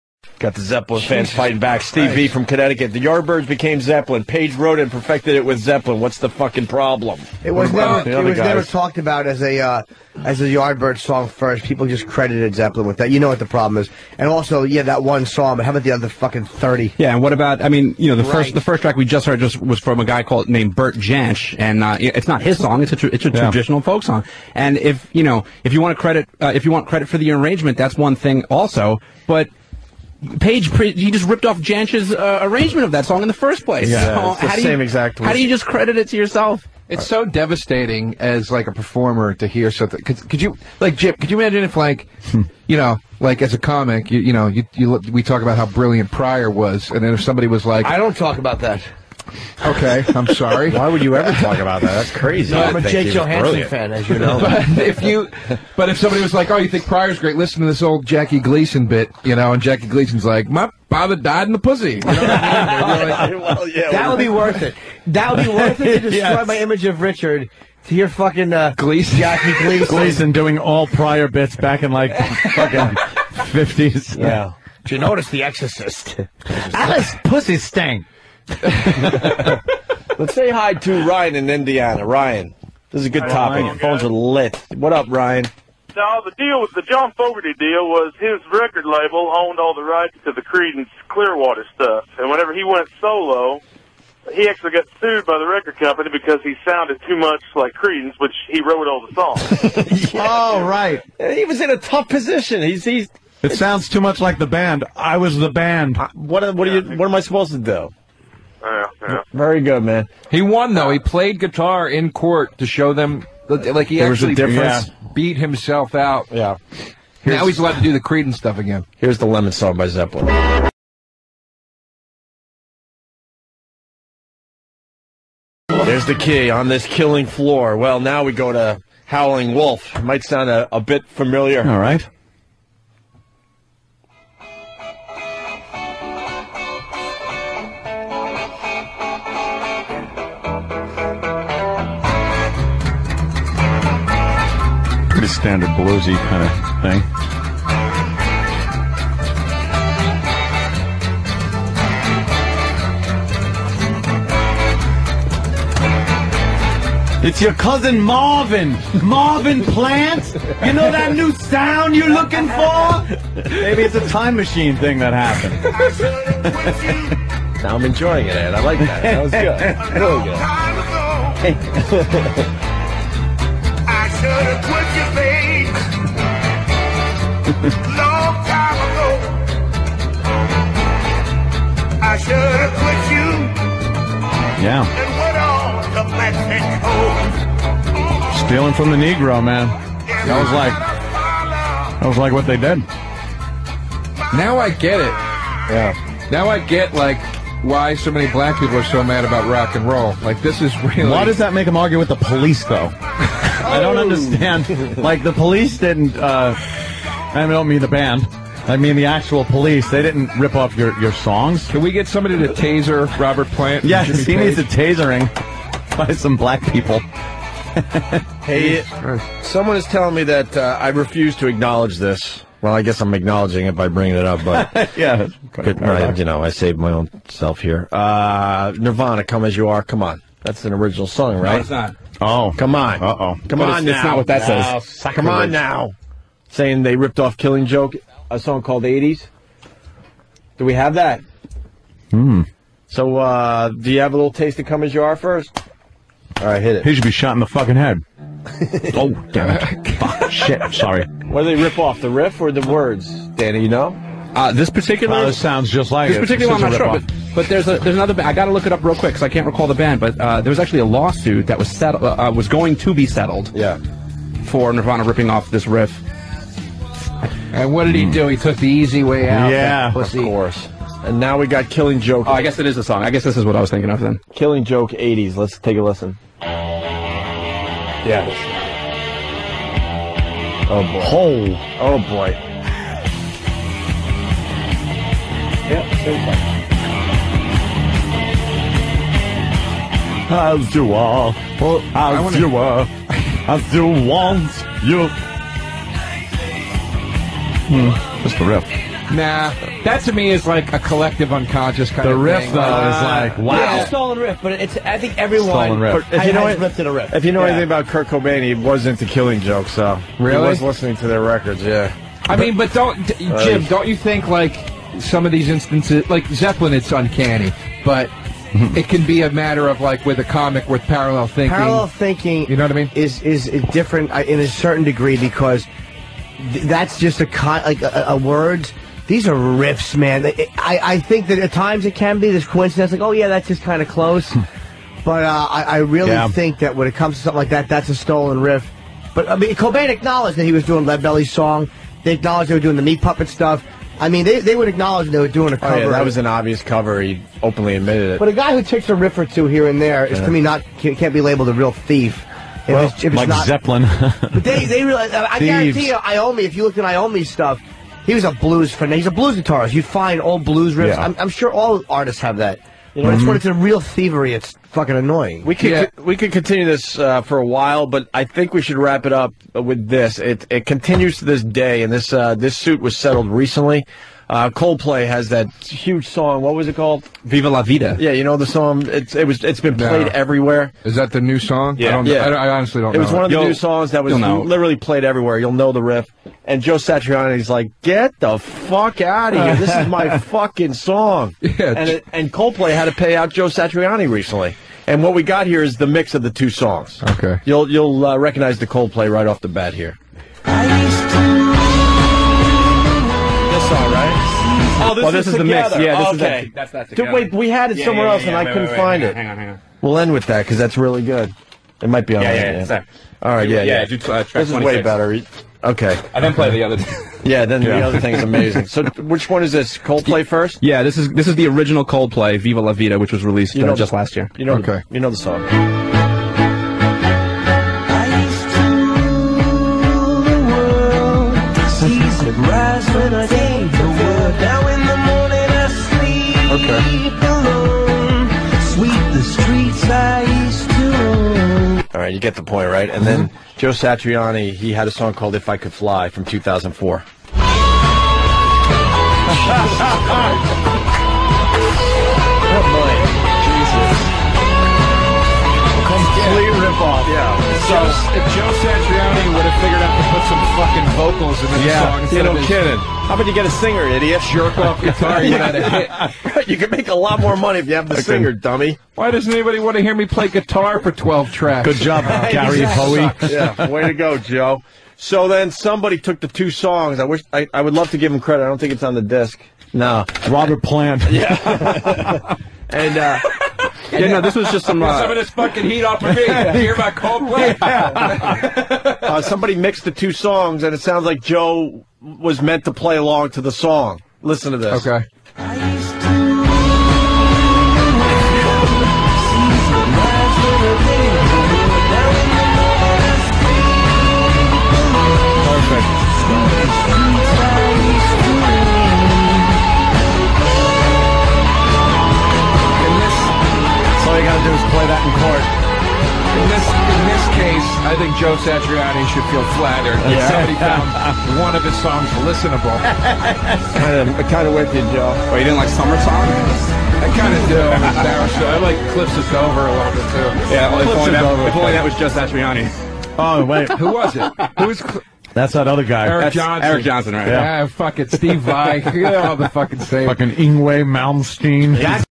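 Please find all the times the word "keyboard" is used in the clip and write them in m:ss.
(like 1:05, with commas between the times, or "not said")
not said.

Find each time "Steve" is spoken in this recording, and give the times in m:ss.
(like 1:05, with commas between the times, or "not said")
0:01, 8:58.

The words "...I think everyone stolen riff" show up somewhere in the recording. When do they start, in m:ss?
5:04.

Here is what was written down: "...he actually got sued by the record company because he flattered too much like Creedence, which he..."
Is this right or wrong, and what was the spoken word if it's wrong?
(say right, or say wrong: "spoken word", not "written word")
wrong: "sounded", not "flattered".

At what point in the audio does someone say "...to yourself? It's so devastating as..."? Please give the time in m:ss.
0:36.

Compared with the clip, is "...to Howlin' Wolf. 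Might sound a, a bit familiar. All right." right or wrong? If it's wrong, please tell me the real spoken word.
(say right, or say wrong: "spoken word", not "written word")
right.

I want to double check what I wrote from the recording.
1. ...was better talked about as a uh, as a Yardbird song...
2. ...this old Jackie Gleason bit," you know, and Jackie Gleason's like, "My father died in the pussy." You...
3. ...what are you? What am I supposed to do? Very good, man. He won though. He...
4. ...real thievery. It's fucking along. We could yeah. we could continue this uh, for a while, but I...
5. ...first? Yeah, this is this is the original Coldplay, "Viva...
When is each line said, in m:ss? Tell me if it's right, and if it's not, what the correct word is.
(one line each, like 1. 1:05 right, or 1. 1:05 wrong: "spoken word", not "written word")
1. 0:08 wrong: "never", not "better"
2. 0:57 right
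3. 1:46 right
4. 6:03 wrong: "annoying", not "along"
5. 7:00 right.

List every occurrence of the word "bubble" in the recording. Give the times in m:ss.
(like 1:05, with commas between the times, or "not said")
not said.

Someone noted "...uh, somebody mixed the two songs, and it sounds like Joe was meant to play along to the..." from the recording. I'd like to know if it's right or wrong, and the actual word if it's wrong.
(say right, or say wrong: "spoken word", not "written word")
right.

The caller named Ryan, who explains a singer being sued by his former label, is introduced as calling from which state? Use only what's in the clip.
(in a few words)
Indiana.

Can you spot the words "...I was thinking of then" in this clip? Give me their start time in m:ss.
4:33.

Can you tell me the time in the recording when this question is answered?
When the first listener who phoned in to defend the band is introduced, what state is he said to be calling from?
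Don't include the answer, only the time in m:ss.
0:02.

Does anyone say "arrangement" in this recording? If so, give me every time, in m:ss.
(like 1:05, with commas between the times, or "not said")
0:27, 0:32.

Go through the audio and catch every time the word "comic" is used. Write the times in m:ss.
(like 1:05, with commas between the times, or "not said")
0:43, 5:20.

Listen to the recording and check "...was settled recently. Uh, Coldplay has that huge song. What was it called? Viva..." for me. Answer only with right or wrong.
right.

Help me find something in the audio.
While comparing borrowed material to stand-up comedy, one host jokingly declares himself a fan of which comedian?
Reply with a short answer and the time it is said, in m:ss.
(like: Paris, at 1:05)
Jake Johannsen, at 0:52.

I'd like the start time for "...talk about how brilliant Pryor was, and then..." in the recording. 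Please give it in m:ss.
0:45.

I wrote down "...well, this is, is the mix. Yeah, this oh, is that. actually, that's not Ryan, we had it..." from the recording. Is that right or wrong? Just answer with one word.
wrong.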